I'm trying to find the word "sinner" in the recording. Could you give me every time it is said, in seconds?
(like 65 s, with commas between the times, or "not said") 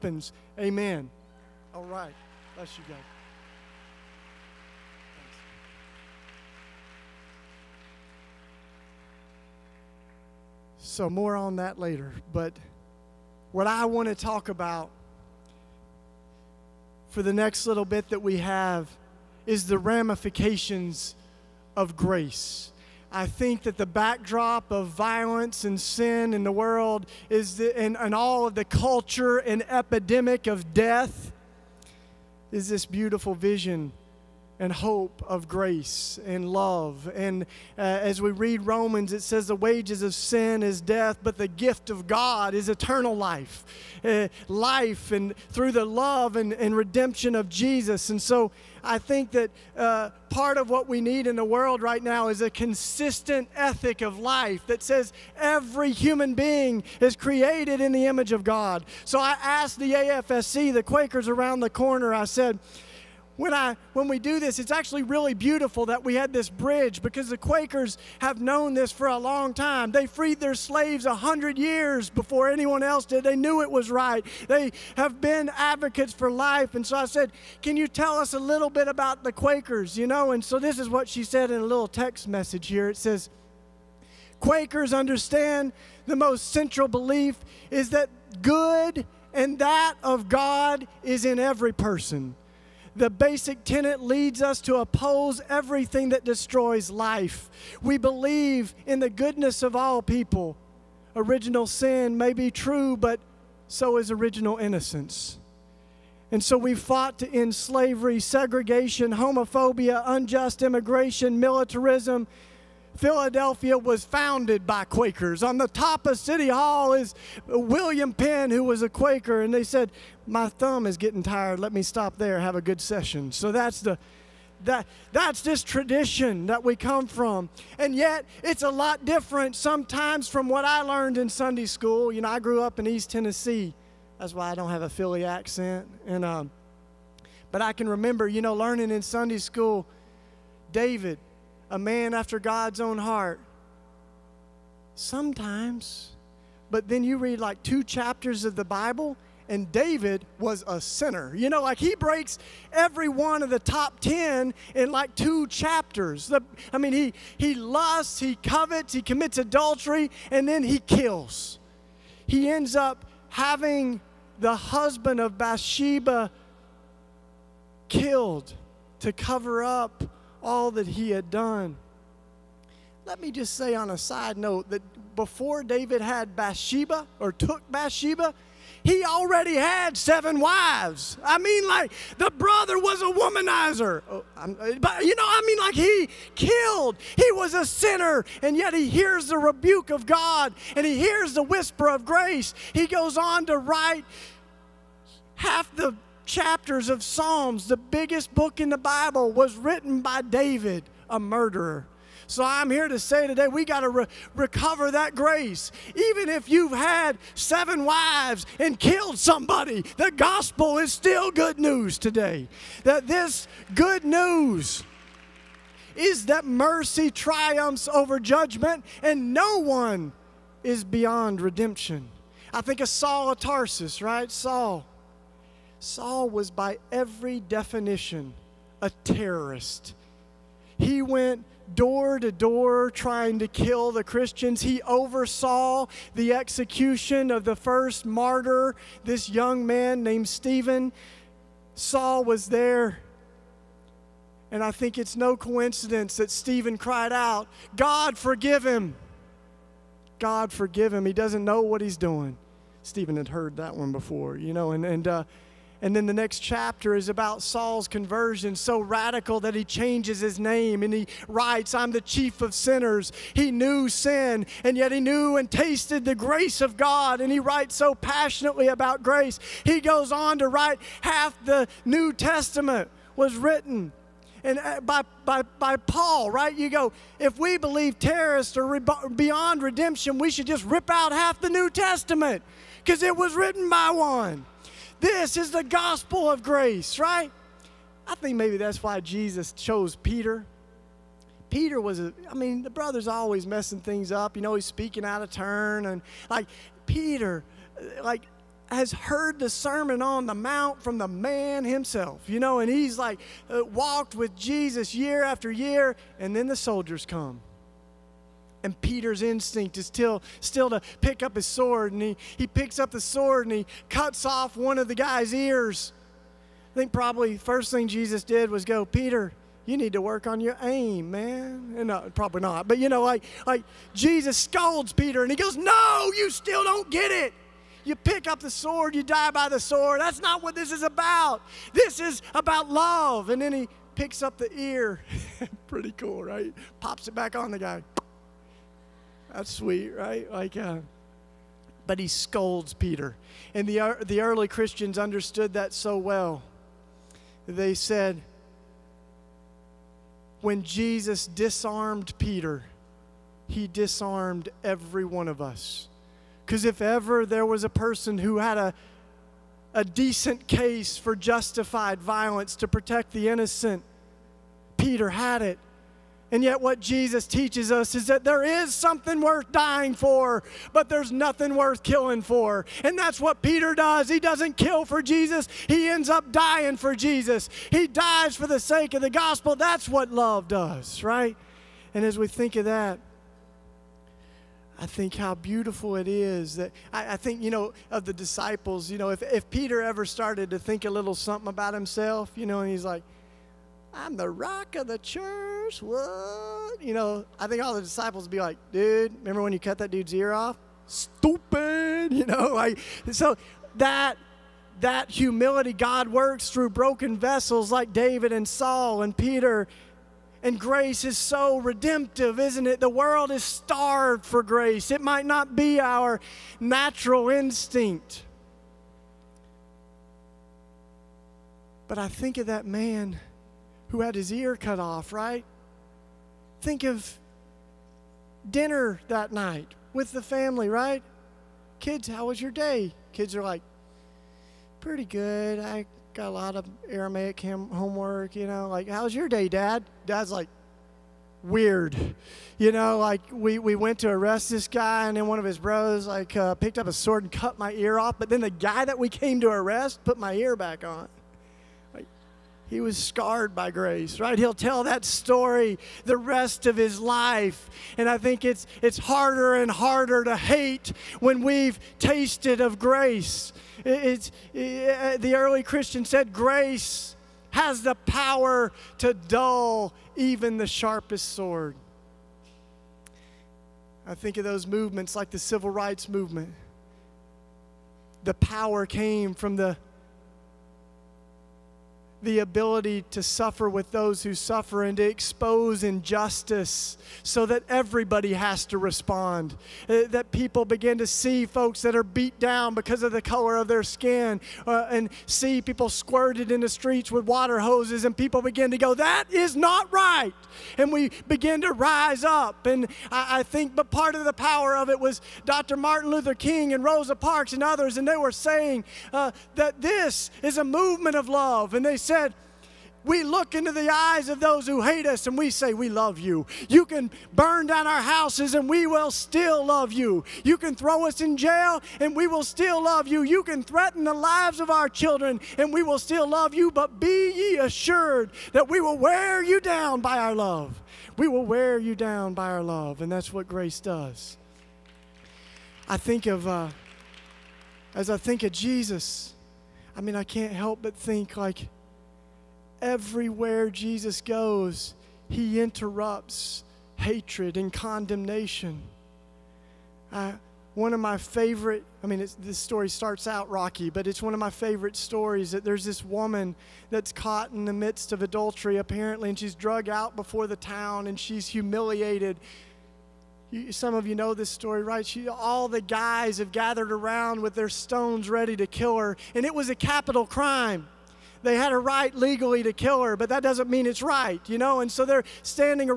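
150 s, 187 s, 262 s.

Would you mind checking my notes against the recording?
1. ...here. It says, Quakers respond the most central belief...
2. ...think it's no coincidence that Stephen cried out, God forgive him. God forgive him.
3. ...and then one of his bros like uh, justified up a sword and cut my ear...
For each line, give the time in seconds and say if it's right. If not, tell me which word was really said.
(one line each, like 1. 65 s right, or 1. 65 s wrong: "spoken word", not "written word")
1. 82 s wrong: "understand", not "respond"
2. 244 s right
3. 445 s wrong: "picked", not "justified".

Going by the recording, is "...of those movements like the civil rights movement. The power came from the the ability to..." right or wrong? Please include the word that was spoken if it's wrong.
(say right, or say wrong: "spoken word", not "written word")
right.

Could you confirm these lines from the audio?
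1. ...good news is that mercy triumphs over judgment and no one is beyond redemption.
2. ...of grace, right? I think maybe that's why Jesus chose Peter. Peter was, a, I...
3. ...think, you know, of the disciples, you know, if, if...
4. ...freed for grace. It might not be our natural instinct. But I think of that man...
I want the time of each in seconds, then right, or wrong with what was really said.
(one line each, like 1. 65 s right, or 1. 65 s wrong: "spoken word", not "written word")
1. 213 s right
2. 286 s right
3. 387 s right
4. 413 s wrong: "starved", not "freed".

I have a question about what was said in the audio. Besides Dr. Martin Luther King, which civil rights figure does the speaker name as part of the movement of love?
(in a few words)
Rosa Parks.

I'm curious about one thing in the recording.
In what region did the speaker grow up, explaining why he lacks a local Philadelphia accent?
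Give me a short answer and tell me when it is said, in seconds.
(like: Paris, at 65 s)
East Tennessee, at 132 s.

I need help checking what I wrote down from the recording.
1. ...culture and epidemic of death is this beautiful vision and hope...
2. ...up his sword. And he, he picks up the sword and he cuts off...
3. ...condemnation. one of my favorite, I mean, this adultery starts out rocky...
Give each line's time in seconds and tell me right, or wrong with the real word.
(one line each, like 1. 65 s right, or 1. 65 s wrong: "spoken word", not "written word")
1. 28 s right
2. 311 s right
3. 547 s wrong: "story", not "adultery".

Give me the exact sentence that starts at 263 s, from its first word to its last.
He knew sin, and yet he knew and tasted the grace of God, and he writes so passionately about grace.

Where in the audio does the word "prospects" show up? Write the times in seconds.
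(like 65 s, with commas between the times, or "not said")
not said.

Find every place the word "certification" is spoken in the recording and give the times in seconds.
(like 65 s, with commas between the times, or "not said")
not said.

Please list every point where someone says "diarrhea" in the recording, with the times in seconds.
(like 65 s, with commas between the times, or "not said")
not said.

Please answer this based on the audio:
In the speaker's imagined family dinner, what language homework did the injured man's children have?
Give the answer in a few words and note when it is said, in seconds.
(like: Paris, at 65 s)
Aramaic, at 436 s.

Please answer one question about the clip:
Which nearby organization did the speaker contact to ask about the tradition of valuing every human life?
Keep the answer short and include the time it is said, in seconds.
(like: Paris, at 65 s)
AFSC, at 59 s.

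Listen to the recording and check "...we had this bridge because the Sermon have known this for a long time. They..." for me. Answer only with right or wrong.
wrong.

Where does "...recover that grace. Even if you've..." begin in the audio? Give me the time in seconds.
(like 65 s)
204 s.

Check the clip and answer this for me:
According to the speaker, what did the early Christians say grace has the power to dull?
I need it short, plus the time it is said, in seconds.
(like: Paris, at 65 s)
the sharpest sword, at 470 s.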